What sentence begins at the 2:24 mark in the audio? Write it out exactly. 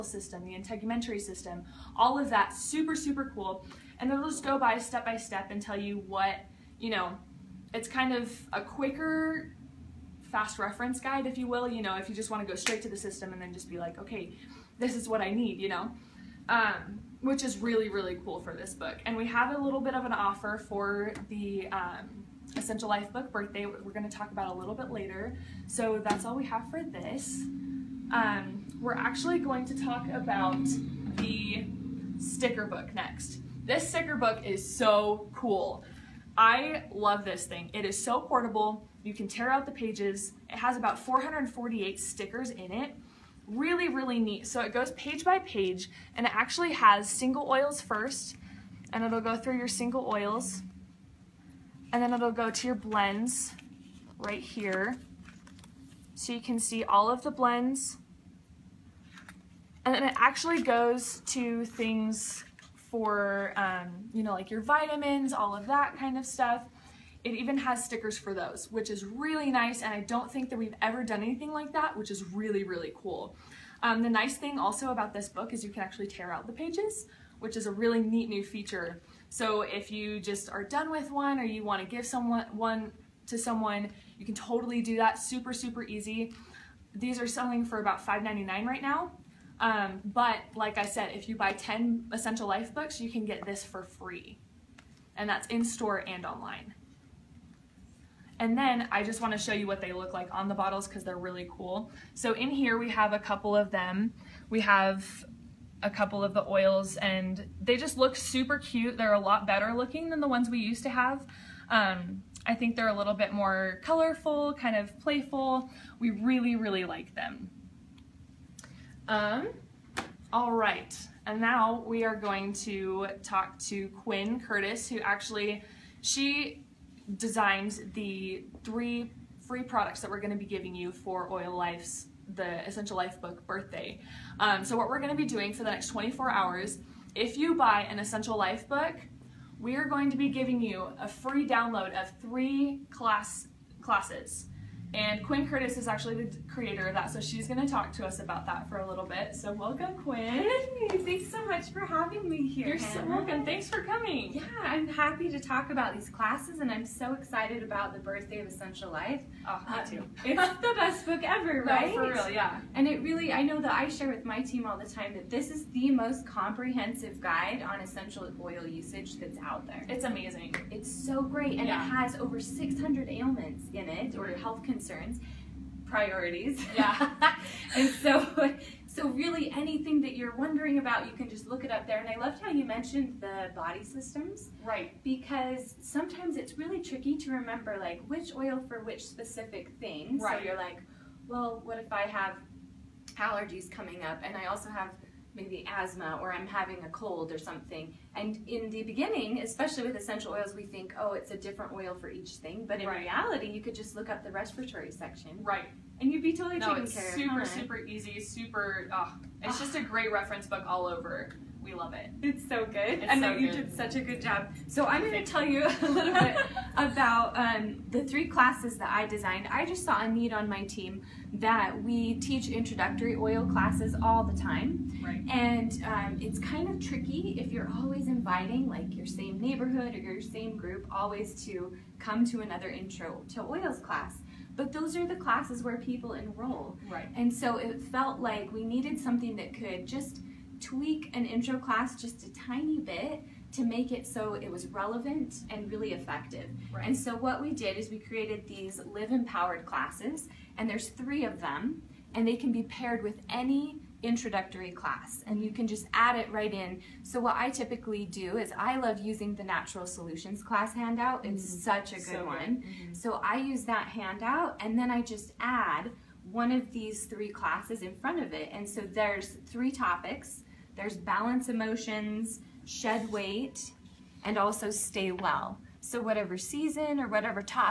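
And Quinn Curtis is actually the creator of that, so she's going to talk to us about that for a little bit.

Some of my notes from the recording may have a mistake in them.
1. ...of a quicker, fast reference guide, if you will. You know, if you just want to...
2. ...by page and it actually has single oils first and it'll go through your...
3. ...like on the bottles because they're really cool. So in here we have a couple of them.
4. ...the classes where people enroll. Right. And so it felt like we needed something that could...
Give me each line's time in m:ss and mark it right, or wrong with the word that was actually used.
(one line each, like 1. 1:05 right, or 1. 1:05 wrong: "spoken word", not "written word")
1. 0:08 right
2. 0:45 right
3. 1:40 right
4. 3:55 right.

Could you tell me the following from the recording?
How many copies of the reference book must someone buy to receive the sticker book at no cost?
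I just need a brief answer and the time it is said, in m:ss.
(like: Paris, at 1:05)
10, at 1:31.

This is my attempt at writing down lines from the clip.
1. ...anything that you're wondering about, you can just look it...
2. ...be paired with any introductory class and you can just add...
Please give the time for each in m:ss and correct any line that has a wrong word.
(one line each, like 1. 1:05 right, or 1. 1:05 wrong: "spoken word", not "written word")
1. 2:59 right
2. 4:12 right.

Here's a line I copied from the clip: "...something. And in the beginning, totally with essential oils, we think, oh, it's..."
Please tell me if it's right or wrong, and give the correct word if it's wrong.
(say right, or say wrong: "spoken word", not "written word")
wrong: "especially", not "totally".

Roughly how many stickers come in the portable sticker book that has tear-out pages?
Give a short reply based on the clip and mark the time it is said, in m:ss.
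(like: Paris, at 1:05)
448, at 0:40.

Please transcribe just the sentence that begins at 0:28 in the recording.
Um, we're actually going to talk about the sticker book next.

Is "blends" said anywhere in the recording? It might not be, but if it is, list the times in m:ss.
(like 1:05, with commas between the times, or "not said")
0:52, 0:57.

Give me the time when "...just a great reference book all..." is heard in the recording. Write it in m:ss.
3:29.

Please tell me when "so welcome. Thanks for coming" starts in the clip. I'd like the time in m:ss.
2:33.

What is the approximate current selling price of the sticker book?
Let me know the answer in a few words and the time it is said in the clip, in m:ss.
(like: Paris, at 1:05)
$5.99, at 1:28.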